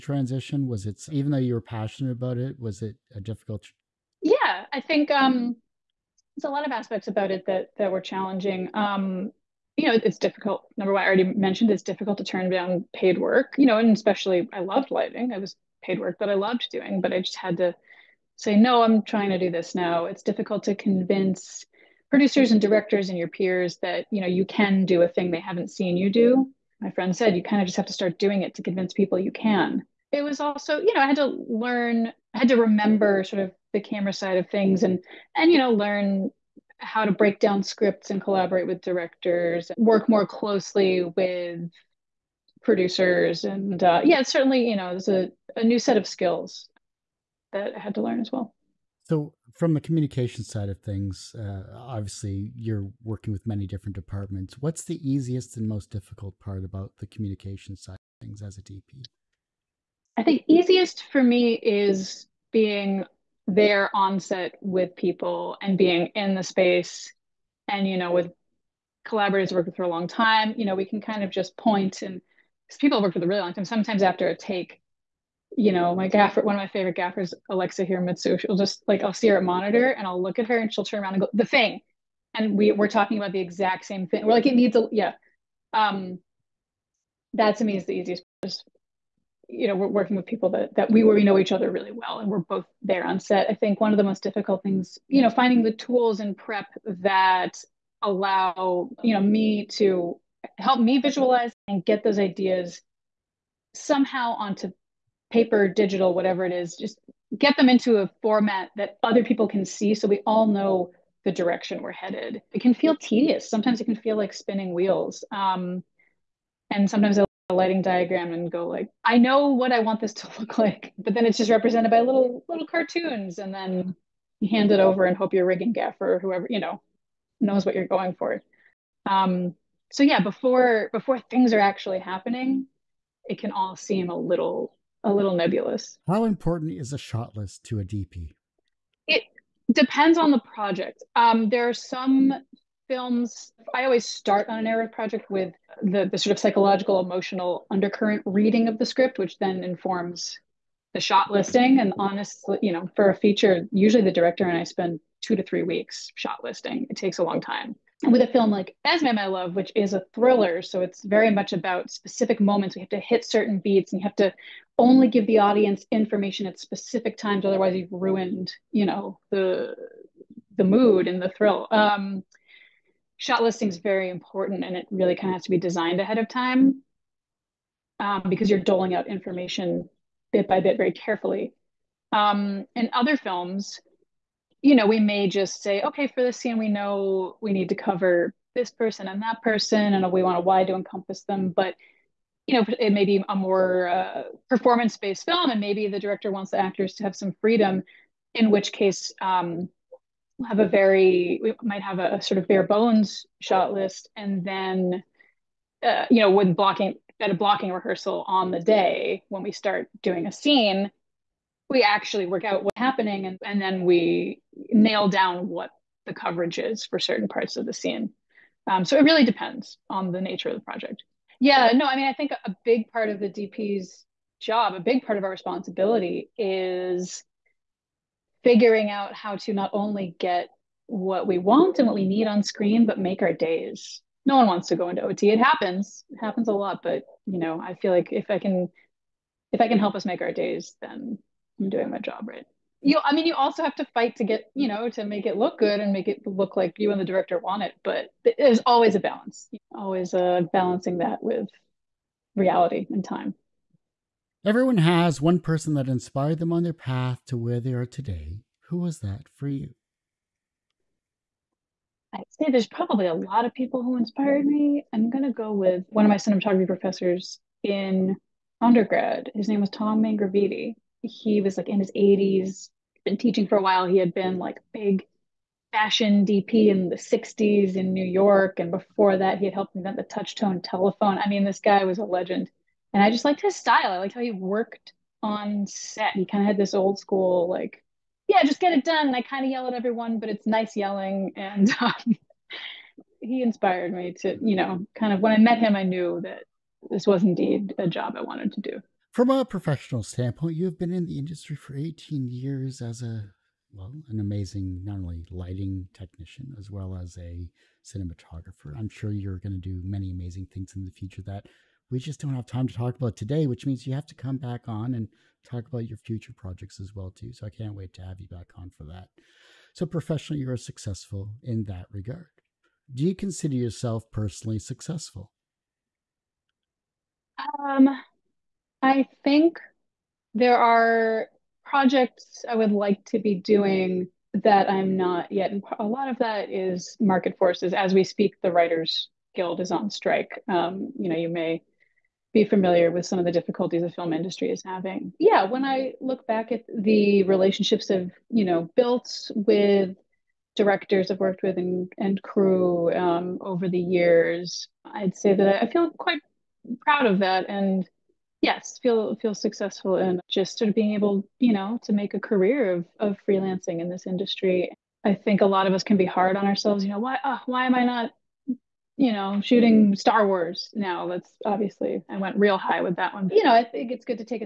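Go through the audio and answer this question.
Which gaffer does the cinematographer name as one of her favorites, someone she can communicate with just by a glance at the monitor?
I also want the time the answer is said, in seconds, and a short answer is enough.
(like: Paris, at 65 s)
Alexa Hiramitsu, at 77 s.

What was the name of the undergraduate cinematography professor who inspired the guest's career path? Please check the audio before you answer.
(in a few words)
Tom Mangraviti.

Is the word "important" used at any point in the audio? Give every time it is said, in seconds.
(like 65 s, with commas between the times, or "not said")
136 s, 174 s.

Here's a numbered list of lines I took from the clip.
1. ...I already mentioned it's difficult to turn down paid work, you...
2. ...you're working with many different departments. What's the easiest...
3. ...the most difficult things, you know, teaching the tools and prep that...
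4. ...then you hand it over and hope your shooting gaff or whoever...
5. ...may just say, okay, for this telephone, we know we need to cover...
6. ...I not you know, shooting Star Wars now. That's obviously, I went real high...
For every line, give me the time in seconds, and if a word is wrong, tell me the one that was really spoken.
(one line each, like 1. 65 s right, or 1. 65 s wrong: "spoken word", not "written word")
1. 11 s right
2. 52 s right
3. 93 s wrong: "finding", not "teaching"
4. 123 s wrong: "rigging", not "shooting"
5. 184 s wrong: "scene", not "telephone"
6. 367 s right.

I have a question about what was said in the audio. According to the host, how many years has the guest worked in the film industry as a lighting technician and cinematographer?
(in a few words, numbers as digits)
18.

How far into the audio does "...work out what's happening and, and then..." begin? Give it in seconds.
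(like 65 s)
212 s.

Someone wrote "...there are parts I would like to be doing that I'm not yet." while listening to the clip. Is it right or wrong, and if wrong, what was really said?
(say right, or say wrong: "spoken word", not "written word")
wrong: "projects", not "parts".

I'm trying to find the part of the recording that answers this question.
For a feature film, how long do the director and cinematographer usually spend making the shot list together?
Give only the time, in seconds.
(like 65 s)
155 s.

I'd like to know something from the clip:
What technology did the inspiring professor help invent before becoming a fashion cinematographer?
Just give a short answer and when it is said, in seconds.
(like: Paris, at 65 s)
touch tone telephone, at 280 s.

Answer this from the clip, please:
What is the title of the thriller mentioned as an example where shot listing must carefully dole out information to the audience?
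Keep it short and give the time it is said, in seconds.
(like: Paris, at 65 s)
Esme I Love, at 158 s.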